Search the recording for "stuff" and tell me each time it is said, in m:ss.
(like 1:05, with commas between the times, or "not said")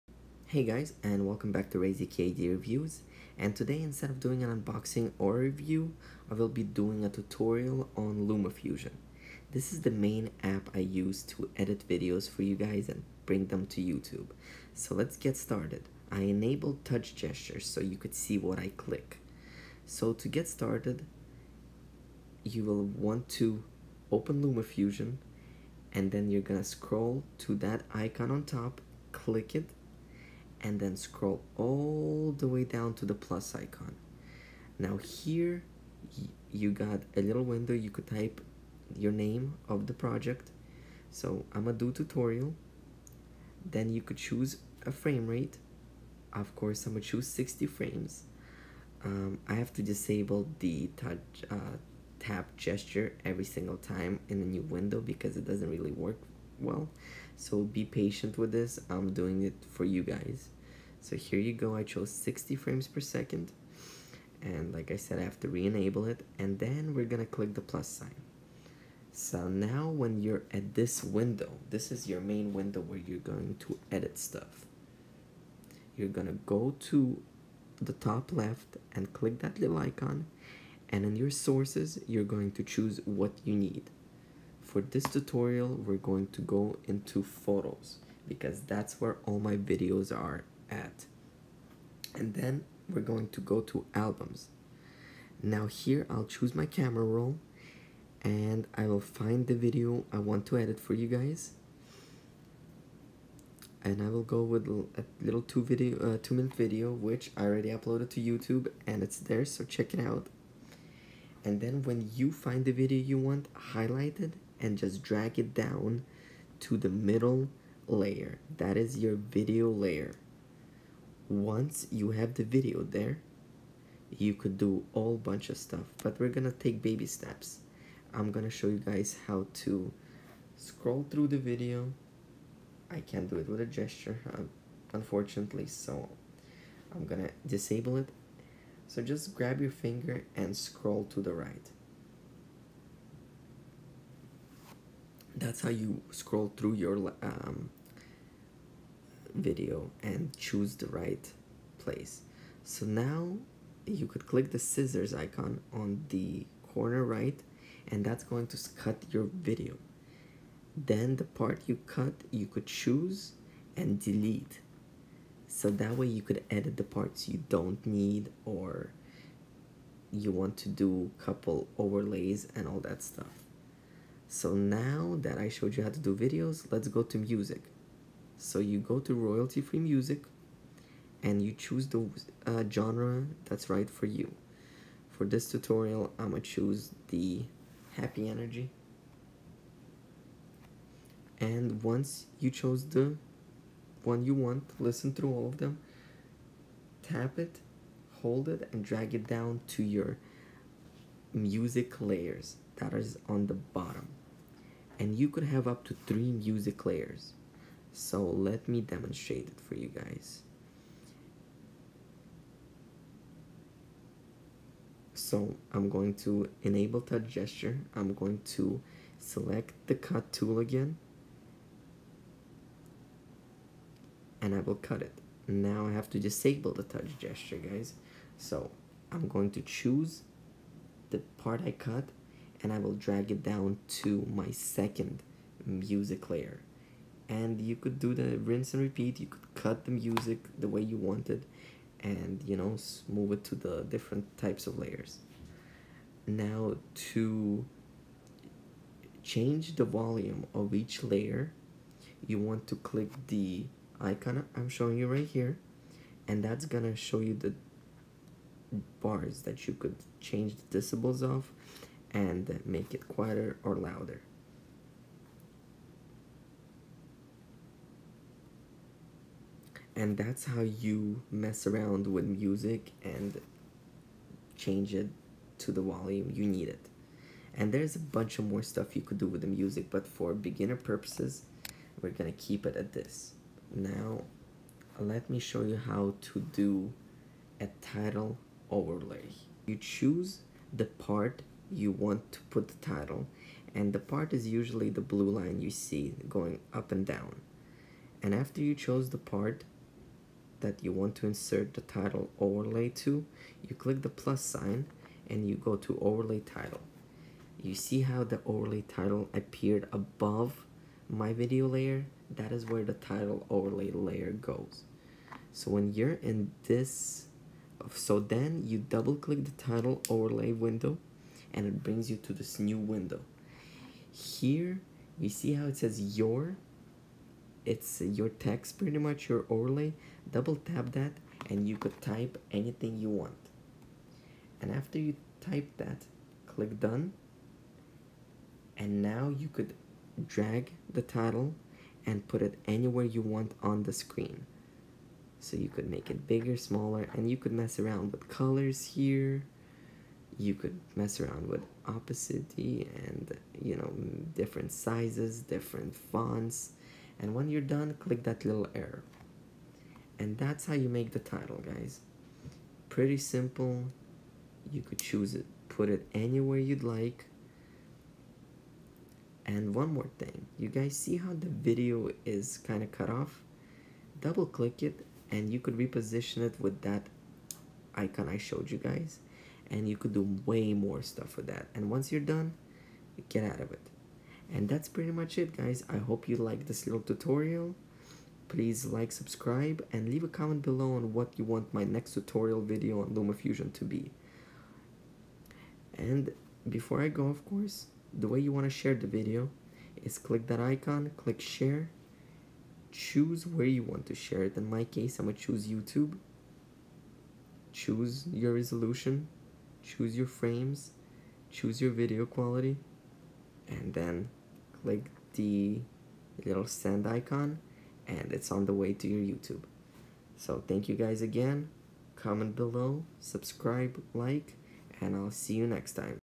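1:14, 2:05, 2:53, 4:38, 6:21.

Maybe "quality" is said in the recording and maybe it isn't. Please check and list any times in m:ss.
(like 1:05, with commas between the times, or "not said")
6:52.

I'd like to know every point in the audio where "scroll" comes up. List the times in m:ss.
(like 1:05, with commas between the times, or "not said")
0:26, 0:30, 2:10, 2:20, 2:26.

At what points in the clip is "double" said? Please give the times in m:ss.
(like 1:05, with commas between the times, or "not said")
5:18, 5:30, 6:14.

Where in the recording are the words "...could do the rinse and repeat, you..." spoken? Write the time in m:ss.
3:57.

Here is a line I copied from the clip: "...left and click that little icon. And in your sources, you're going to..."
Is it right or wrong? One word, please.
right.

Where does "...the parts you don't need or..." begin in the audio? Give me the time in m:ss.
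2:46.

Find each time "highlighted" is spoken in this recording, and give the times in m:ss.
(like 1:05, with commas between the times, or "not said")
1:53.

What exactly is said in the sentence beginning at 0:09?
This is the main app I use to edit videos for you guys and bring them to YouTube.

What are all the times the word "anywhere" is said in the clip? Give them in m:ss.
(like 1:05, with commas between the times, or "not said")
5:42, 6:06.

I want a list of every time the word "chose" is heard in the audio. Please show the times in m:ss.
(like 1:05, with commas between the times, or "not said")
1:01, 3:12, 4:58.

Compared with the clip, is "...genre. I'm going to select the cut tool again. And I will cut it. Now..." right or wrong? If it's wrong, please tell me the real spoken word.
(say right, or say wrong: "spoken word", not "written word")
wrong: "gesture", not "genre".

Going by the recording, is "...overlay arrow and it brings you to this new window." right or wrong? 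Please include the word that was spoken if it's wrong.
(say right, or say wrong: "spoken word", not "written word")
wrong: "window", not "arrow".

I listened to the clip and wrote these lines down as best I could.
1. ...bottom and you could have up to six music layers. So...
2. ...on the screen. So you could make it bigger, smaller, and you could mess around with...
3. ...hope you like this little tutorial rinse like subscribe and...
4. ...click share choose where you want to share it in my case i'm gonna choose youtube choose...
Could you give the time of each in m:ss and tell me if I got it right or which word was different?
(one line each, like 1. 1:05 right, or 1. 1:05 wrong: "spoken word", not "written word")
1. 3:23 wrong: "three", not "six"
2. 5:43 right
3. 6:25 wrong: "please", not "rinse"
4. 6:41 right.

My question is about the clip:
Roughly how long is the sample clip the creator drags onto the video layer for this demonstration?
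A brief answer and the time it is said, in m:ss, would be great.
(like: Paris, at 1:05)
2 minutes, at 1:46.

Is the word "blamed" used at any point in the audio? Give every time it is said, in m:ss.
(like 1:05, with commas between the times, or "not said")
not said.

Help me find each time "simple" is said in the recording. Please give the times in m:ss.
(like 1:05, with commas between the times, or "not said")
6:03.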